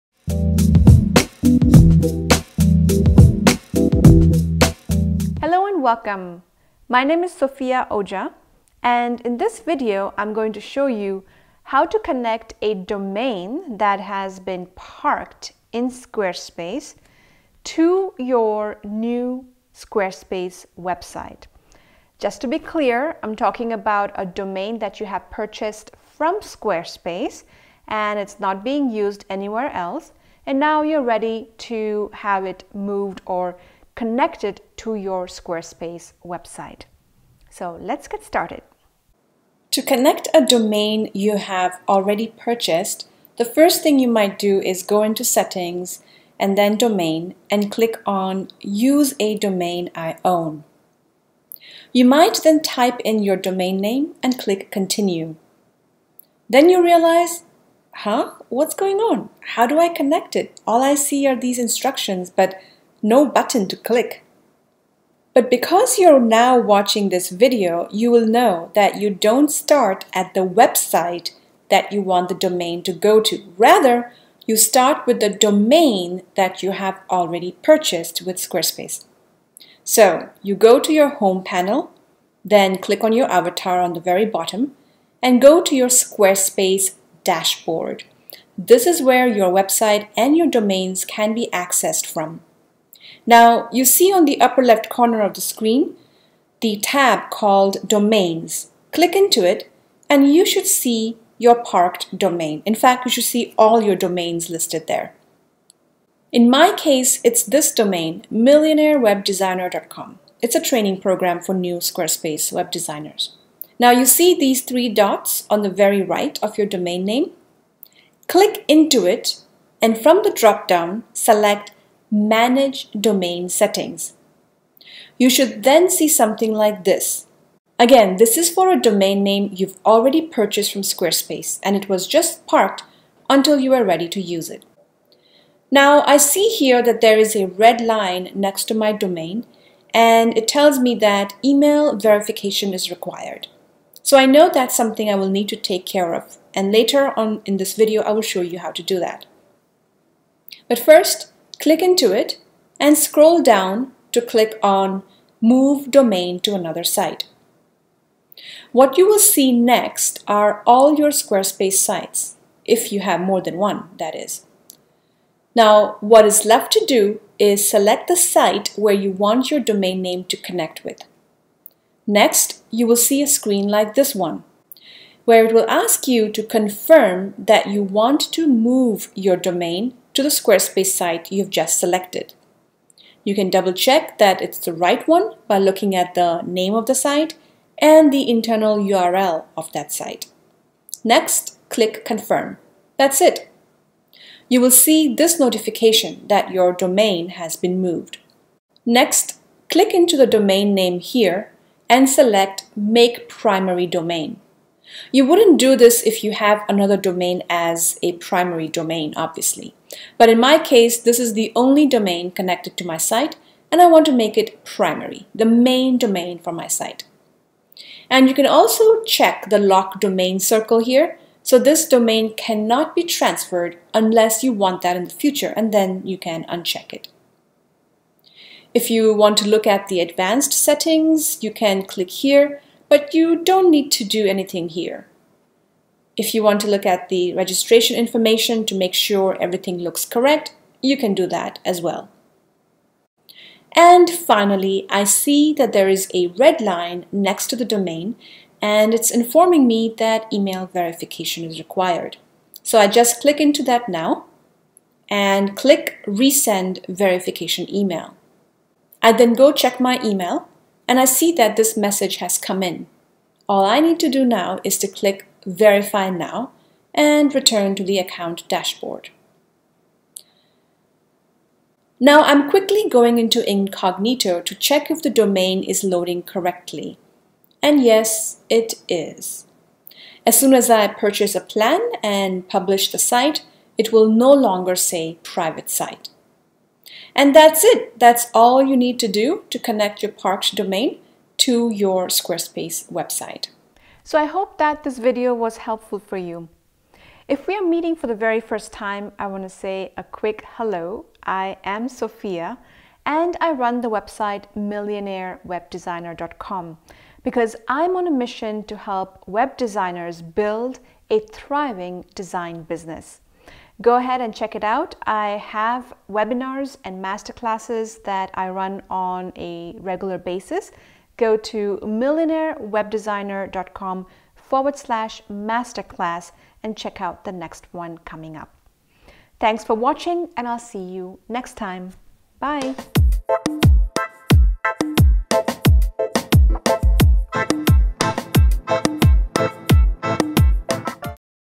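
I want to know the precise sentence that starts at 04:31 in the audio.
Now I'm quickly going into incognito to check if the domain is loading correctly.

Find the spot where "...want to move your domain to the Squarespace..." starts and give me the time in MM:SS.
02:57.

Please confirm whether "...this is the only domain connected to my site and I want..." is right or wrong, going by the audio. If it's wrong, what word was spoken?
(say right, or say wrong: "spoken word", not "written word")
right.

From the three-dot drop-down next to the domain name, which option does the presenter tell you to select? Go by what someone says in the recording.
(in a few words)
Manage Domain Settings.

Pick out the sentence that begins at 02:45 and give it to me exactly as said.
Now, what is left to do is select the site where you want your domain name to connect with.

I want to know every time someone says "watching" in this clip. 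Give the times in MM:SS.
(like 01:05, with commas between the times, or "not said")
01:06, 05:29.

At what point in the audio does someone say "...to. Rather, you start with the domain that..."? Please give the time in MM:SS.
01:13.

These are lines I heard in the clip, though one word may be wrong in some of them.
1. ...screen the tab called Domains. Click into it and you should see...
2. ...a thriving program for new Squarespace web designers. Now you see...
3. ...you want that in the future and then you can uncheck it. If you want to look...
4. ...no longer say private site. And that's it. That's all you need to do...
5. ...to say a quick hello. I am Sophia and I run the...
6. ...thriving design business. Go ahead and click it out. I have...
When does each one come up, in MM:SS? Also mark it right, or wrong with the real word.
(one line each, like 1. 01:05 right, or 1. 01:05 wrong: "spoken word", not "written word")
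1. 01:35 right
2. 01:50 wrong: "training", not "thriving"
3. 03:44 right
4. 04:44 right
5. 04:59 right
6. 05:11 wrong: "check", not "click".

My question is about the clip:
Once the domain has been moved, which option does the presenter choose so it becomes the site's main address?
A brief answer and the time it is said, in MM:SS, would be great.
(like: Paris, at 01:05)
Make Primary Domain, at 03:22.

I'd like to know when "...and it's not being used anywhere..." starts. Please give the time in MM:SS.
00:27.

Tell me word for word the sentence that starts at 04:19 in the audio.
I then go check my email and I see that this message has come in.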